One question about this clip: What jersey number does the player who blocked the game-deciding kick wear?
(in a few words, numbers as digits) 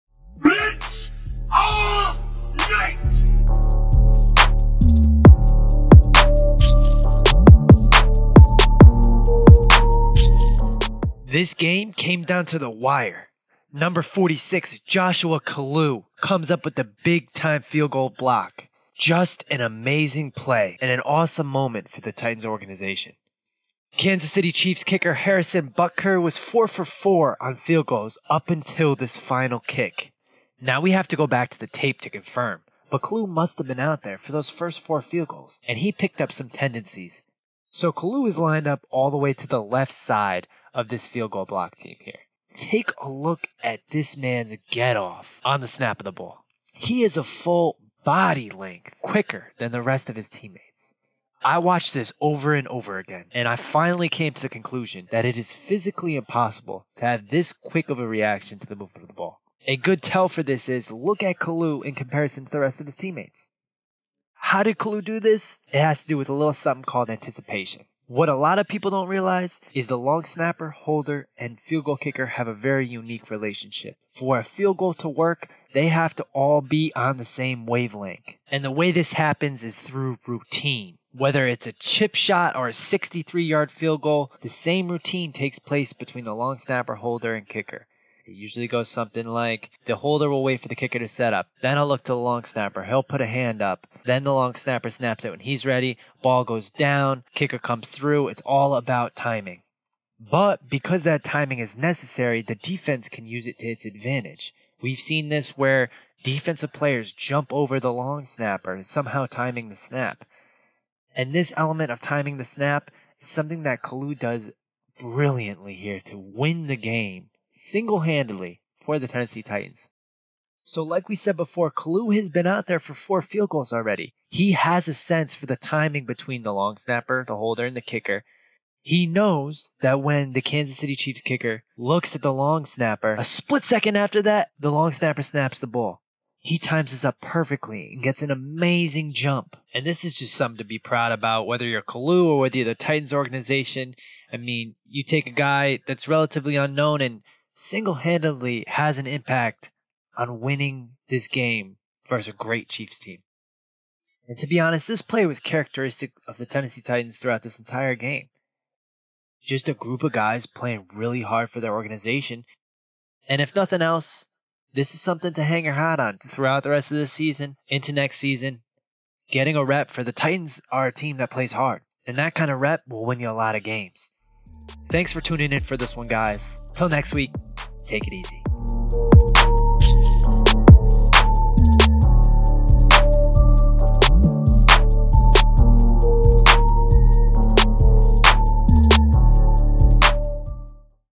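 46.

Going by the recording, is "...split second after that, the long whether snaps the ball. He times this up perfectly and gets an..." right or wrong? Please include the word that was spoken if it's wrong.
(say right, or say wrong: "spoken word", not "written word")
wrong: "snapper", not "whether".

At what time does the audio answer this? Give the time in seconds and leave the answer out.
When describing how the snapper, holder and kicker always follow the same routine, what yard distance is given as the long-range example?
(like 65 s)
82 s.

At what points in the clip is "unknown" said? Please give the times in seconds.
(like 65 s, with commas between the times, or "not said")
146 s.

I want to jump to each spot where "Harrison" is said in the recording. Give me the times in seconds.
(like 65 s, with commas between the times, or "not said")
25 s.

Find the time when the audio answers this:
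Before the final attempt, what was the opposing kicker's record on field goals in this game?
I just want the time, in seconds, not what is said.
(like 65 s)
26 s.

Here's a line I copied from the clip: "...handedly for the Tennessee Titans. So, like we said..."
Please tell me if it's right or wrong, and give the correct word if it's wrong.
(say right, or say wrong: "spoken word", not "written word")
right.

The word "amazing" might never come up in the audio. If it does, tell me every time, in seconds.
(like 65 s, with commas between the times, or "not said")
19 s, 138 s.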